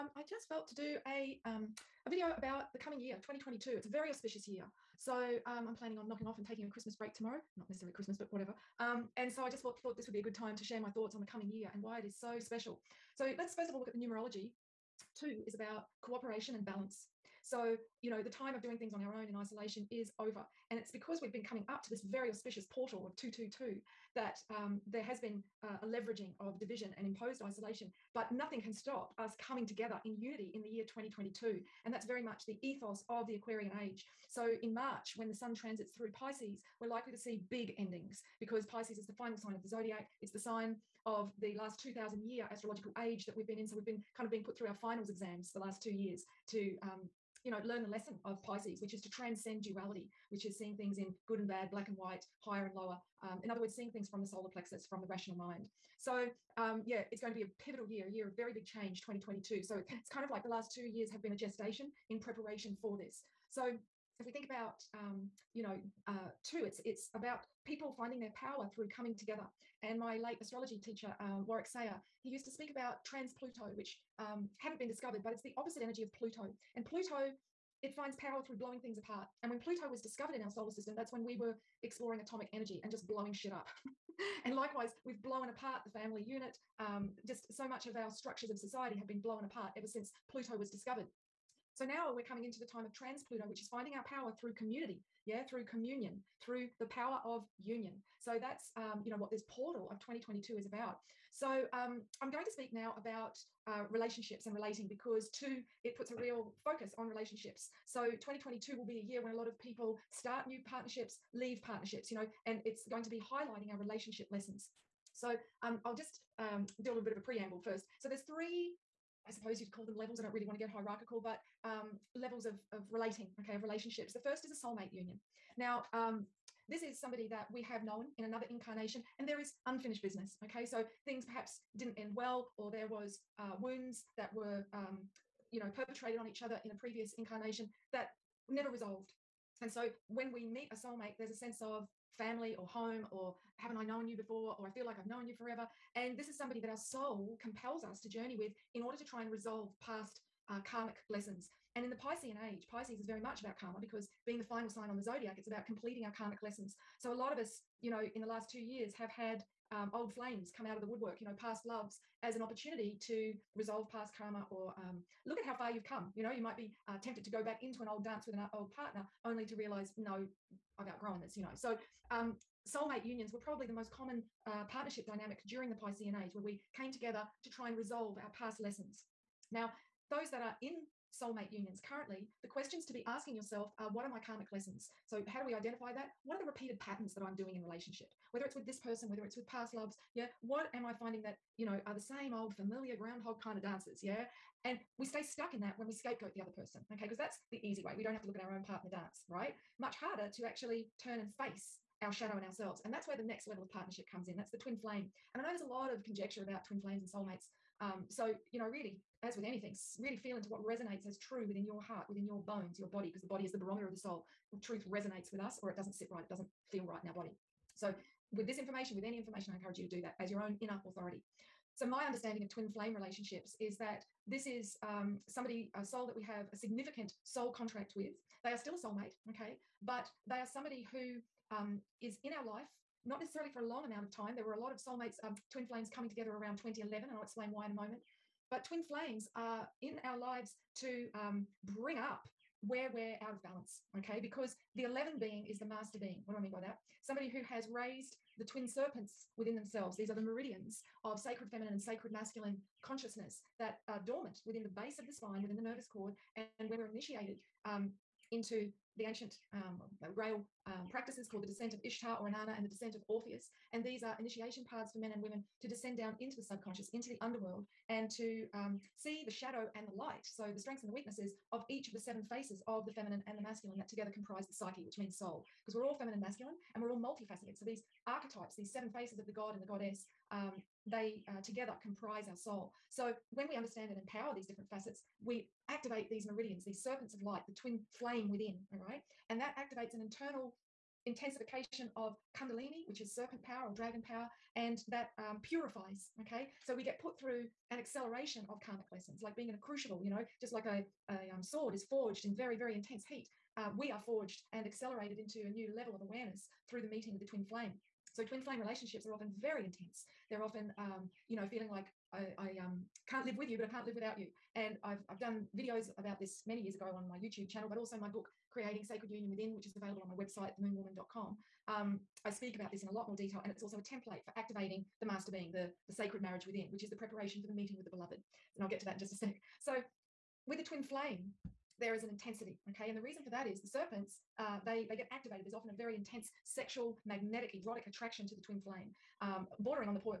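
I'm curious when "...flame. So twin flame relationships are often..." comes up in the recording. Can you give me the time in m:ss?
5:07.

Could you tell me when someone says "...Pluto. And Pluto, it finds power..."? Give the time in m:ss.
1:16.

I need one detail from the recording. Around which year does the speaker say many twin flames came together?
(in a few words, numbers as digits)
2011.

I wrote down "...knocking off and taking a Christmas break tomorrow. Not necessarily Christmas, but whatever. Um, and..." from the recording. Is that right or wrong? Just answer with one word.
right.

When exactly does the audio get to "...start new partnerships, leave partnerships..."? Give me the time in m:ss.
1:50.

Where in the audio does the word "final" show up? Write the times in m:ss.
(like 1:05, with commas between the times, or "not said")
0:39, 0:44, 2:34.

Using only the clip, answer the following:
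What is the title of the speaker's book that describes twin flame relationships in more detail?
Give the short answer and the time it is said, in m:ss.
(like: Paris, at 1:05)
Creating Sacred Union Within, at 5:18.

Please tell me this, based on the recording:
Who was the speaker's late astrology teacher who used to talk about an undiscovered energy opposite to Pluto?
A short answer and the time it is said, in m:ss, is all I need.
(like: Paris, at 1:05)
Warwick Sayer, at 1:11.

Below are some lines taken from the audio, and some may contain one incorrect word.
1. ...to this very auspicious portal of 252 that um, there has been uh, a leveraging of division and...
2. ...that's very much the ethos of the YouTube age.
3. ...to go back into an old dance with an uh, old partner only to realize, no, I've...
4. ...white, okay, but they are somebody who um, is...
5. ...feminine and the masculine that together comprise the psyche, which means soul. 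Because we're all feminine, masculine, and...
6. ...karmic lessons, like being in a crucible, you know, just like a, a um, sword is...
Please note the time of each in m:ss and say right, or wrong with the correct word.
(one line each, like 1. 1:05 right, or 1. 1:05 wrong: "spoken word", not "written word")
1. 0:21 wrong: "222", not "252"
2. 0:31 wrong: "Aquarian", not "YouTube"
3. 2:47 right
4. 3:48 wrong: "soulmate", not "white"
5. 4:32 right
6. 4:58 right.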